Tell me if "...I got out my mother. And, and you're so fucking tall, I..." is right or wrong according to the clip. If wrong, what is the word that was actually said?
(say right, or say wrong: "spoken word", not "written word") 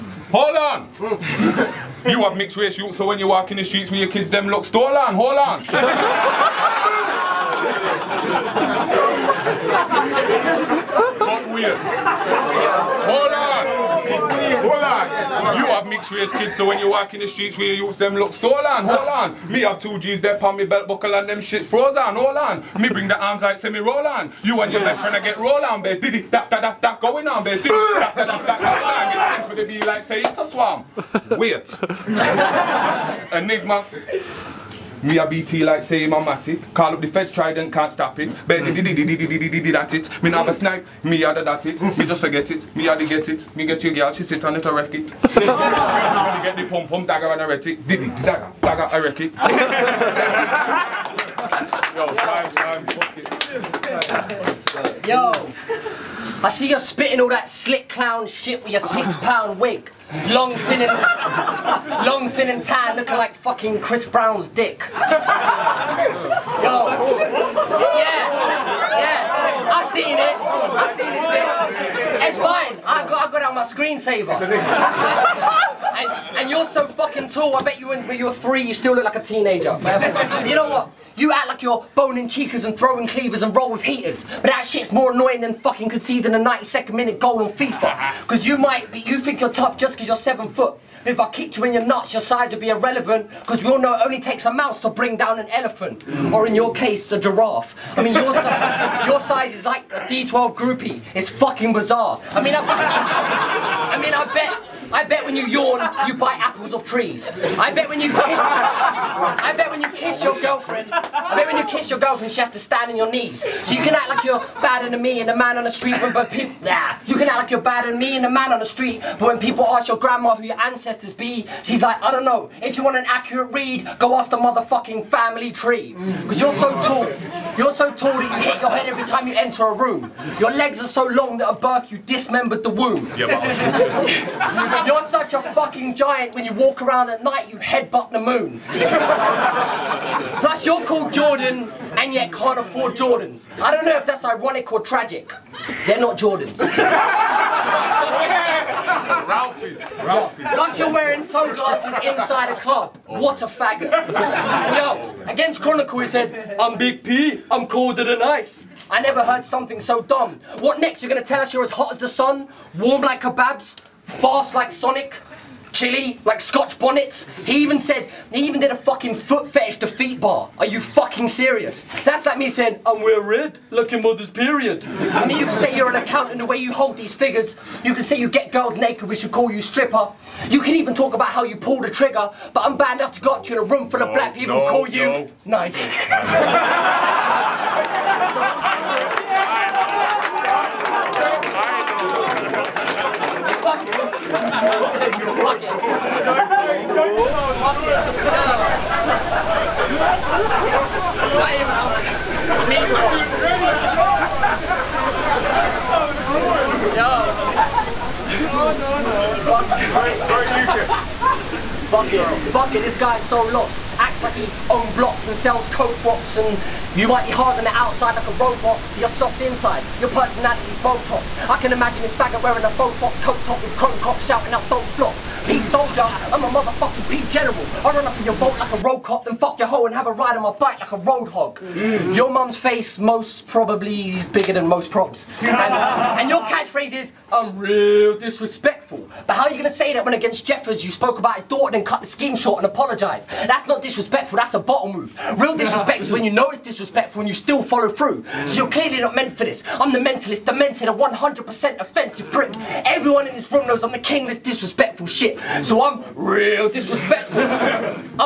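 wrong: "screensaver", not "mother".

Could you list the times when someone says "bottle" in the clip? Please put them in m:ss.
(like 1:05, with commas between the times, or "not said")
4:04.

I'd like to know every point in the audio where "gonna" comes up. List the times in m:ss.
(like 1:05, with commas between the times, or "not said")
2:41, 3:59.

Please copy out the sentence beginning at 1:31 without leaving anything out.
But if I kicked you in your nuts, your size would be irrelevant.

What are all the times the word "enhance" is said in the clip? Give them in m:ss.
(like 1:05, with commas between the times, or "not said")
not said.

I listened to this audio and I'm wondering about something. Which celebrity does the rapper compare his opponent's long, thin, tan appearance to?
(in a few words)
Chris Brown.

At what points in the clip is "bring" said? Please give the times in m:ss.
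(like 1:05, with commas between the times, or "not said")
0:22, 1:34.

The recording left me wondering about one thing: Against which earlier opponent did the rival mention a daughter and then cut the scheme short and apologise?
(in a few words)
Jeffers.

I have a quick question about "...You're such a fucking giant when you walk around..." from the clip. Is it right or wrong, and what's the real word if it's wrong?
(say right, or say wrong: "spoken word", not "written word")
right.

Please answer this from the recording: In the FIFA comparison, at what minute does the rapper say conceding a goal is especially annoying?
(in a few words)
92nd minute.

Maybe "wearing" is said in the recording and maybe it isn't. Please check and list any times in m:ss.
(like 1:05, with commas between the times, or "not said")
2:30, 3:42.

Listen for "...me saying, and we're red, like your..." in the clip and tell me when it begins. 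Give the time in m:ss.
2:52.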